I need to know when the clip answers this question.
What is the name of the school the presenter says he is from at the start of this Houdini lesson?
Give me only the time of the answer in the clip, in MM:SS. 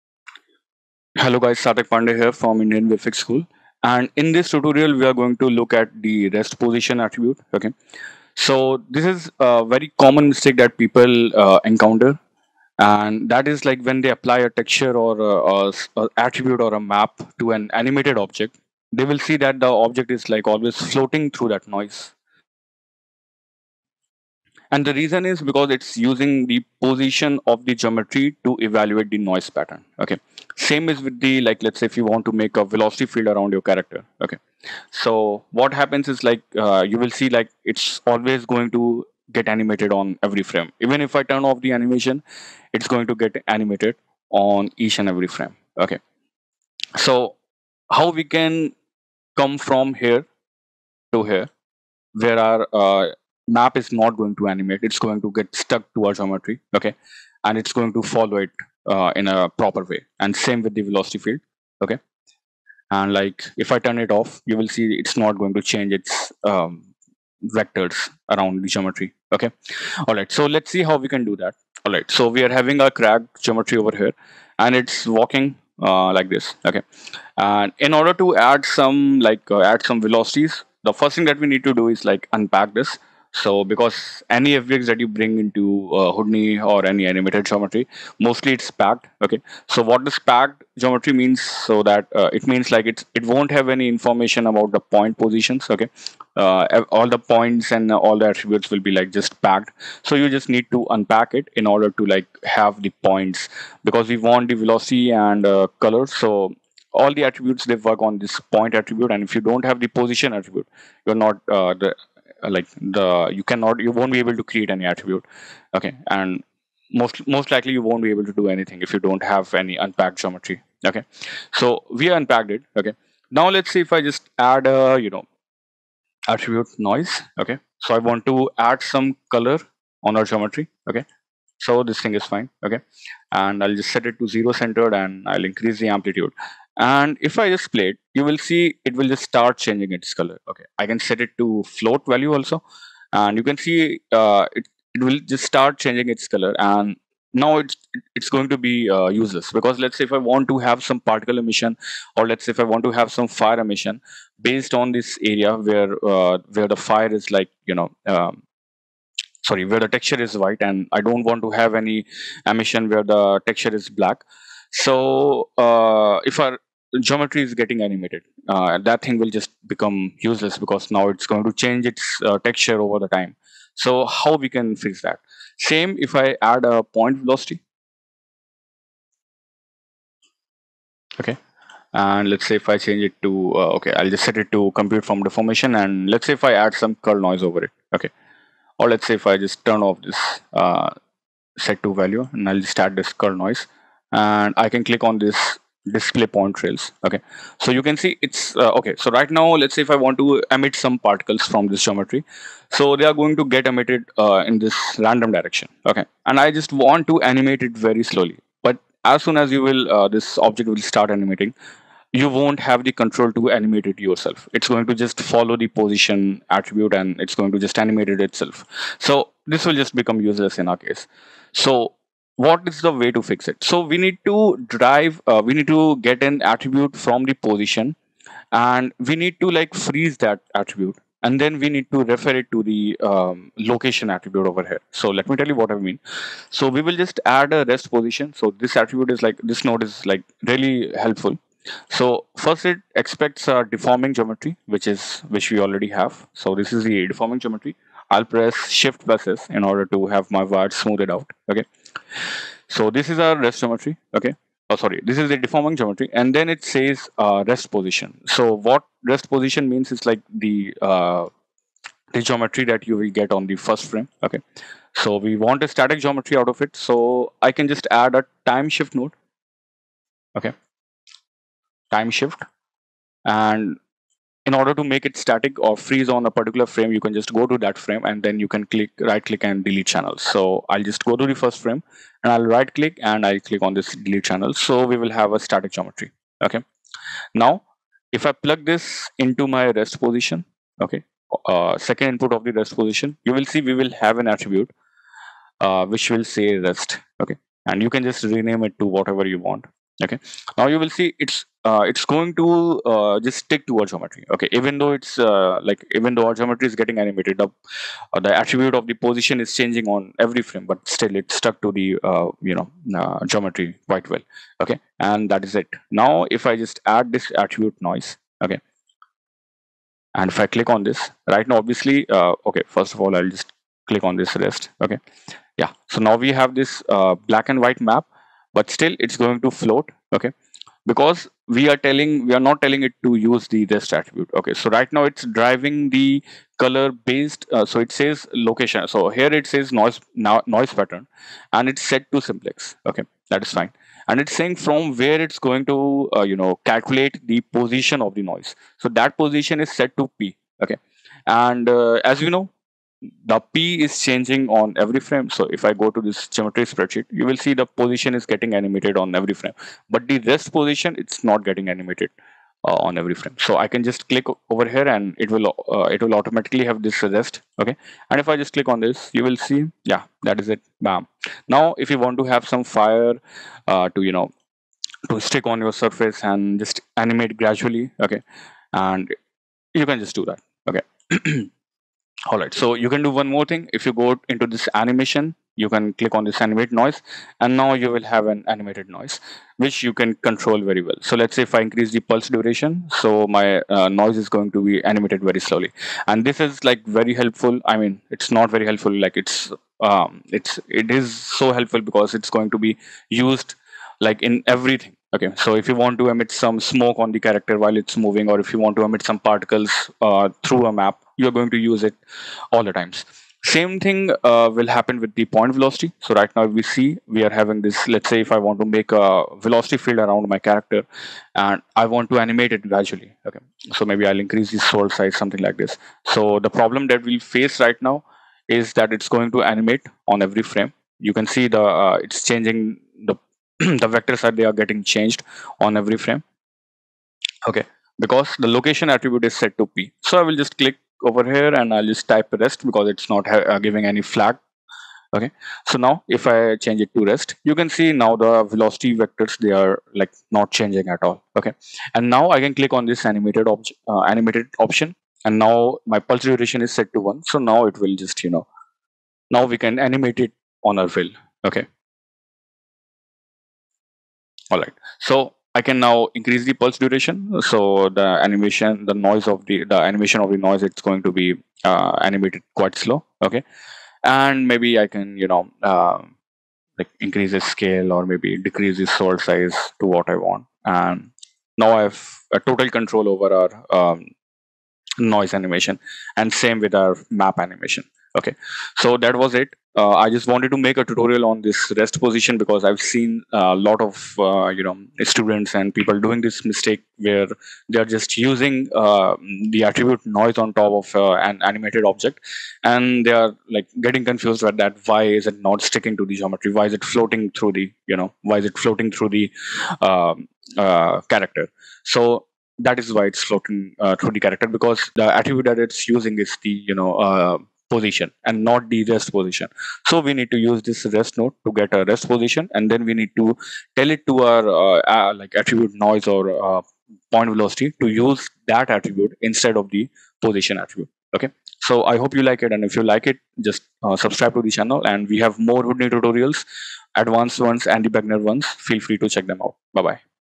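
00:02.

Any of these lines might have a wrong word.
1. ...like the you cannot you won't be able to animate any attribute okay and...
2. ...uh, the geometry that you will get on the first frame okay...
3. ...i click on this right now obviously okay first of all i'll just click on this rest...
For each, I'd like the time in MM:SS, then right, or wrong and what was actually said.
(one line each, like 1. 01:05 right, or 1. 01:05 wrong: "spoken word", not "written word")
1. 01:52 wrong: "create", not "animate"
2. 04:20 right
3. 05:20 right.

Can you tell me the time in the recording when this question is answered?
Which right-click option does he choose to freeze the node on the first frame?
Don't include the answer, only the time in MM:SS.
04:39.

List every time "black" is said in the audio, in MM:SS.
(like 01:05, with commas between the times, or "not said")
02:43, 05:27.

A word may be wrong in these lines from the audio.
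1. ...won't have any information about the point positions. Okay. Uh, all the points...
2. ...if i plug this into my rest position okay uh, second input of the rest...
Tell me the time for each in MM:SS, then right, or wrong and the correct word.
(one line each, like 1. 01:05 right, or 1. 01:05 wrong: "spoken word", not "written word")
1. 01:33 right
2. 04:48 right.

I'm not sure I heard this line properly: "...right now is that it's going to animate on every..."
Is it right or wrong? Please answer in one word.
right.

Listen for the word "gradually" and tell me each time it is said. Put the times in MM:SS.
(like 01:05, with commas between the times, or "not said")
06:17, 07:02.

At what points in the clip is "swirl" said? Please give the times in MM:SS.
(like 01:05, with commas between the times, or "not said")
07:04, 07:58.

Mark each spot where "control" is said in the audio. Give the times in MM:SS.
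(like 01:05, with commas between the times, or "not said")
03:32, 06:30, 08:02.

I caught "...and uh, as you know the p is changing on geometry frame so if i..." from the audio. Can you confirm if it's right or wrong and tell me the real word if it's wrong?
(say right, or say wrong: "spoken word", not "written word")
wrong: "every", not "geometry".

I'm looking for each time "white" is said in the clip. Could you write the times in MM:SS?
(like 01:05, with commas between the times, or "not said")
02:40, 05:27.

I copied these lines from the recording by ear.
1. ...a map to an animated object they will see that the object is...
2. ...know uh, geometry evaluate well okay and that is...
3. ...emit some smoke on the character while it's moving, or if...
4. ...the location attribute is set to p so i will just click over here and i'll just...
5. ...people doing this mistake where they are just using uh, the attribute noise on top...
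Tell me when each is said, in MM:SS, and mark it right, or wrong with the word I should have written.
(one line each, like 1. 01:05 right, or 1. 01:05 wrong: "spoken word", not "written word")
1. 00:16 right
2. 05:12 wrong: "quite", not "evaluate"
3. 06:46 right
4. 07:18 right
5. 08:15 right.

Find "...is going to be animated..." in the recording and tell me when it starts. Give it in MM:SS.
06:34.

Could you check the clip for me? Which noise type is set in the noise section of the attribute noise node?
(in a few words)
simplex.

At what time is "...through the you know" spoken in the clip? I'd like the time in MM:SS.
08:27.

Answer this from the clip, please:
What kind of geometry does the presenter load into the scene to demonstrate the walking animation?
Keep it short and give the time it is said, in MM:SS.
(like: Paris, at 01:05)
crag, at 01:12.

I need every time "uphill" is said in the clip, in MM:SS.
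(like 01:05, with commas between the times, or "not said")
not said.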